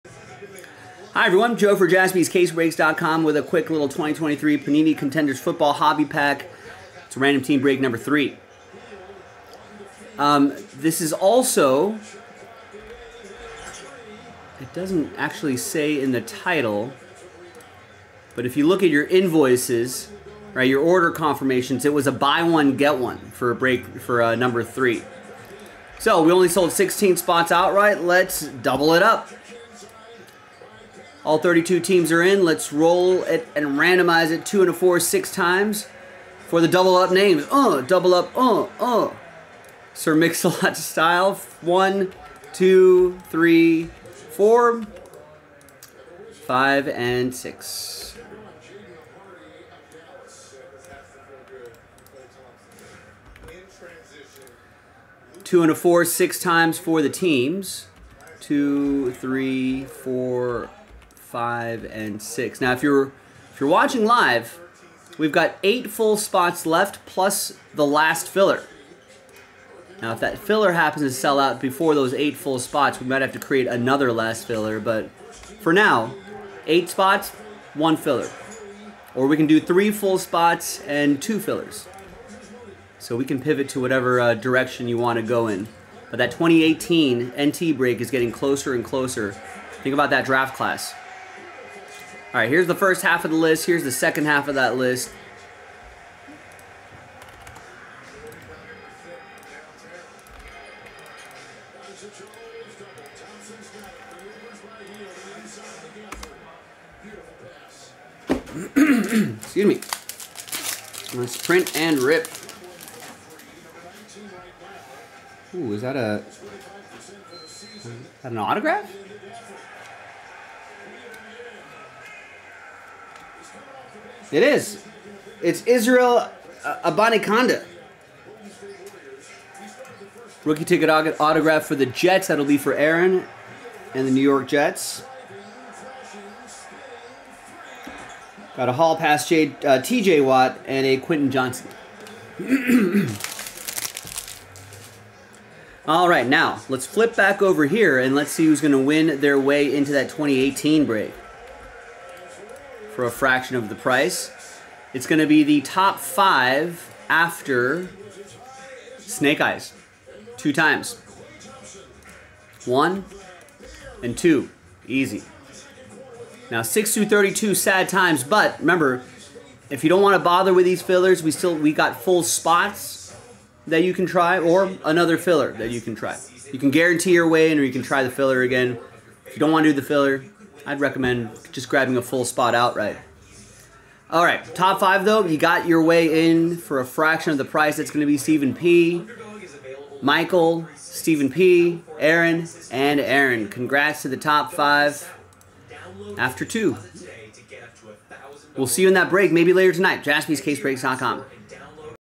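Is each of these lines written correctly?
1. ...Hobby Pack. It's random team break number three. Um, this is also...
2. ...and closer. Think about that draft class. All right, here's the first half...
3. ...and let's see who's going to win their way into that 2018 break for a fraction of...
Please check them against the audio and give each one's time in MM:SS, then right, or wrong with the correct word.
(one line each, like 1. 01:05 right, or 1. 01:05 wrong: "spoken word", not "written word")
1. 00:05 right
2. 01:28 right
3. 02:27 right.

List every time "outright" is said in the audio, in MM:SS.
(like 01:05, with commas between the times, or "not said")
00:27, 03:02.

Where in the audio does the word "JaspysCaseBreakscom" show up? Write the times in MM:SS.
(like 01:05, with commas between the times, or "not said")
00:01, 03:20.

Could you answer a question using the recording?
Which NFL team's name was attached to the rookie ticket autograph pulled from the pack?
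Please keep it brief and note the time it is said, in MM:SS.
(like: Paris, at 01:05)
New York Jets, at 02:14.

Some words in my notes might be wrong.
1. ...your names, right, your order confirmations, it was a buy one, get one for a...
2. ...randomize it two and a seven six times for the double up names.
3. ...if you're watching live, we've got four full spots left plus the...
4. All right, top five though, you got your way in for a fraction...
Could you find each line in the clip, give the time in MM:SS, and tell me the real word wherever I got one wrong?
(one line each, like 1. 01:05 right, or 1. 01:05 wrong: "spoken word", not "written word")
1. 00:18 wrong: "invoices", not "names"
2. 00:33 wrong: "four", not "seven"
3. 01:03 wrong: "eight", not "four"
4. 03:04 right.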